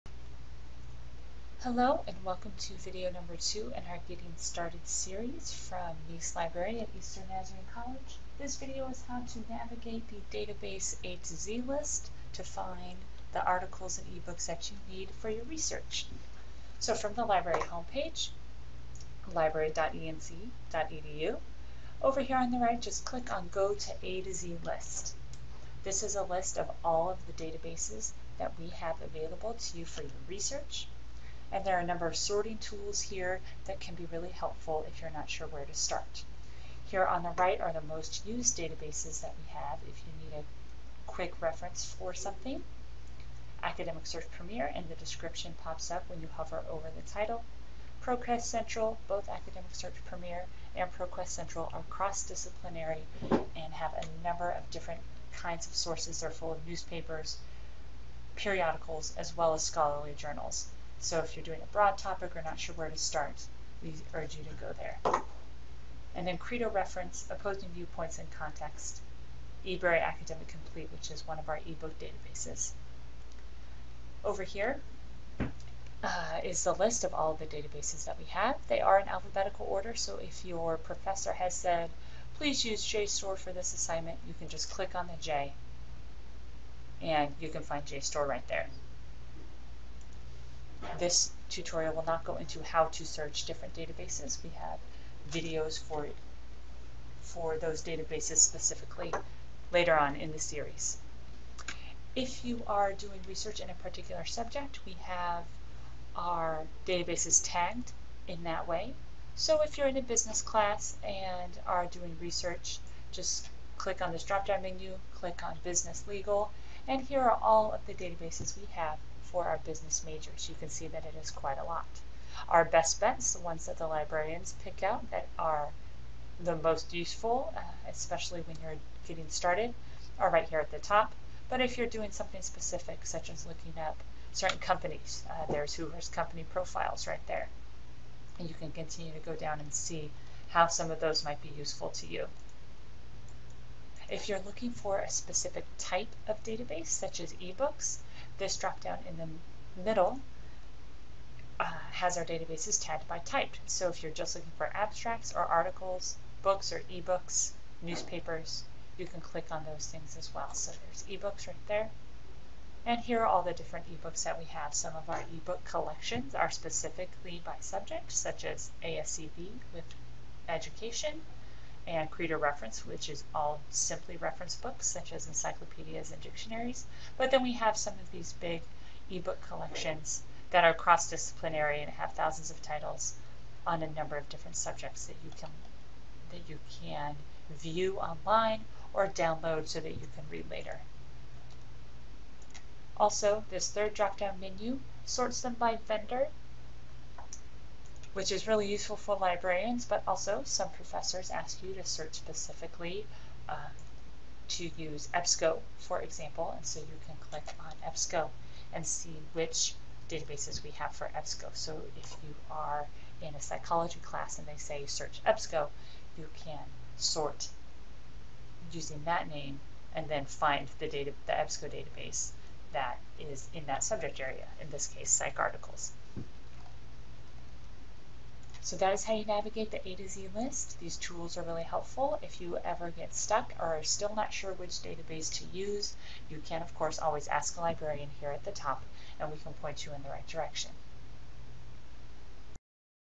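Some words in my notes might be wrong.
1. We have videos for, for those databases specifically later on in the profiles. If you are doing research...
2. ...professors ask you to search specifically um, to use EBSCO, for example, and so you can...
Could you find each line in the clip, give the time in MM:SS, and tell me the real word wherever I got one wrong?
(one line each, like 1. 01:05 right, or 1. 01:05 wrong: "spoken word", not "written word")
1. 01:34 wrong: "series", not "profiles"
2. 03:20 right.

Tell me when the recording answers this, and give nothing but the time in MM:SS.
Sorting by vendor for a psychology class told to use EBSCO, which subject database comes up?
03:45.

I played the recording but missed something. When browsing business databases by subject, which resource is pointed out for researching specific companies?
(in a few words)
Hoover's company profiles.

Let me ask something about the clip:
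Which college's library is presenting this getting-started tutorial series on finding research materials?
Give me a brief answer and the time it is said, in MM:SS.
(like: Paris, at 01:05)
Eastern Nazarene College, at 00:06.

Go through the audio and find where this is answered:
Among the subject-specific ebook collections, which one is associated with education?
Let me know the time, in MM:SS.
02:48.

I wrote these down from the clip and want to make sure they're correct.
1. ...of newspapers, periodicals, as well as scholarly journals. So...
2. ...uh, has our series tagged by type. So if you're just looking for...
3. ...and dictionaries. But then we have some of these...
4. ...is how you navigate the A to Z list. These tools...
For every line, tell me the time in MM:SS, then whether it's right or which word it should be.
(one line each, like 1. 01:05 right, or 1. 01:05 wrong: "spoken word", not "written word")
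1. 00:56 right
2. 02:31 wrong: "databases", not "series"
3. 02:56 right
4. 03:48 right.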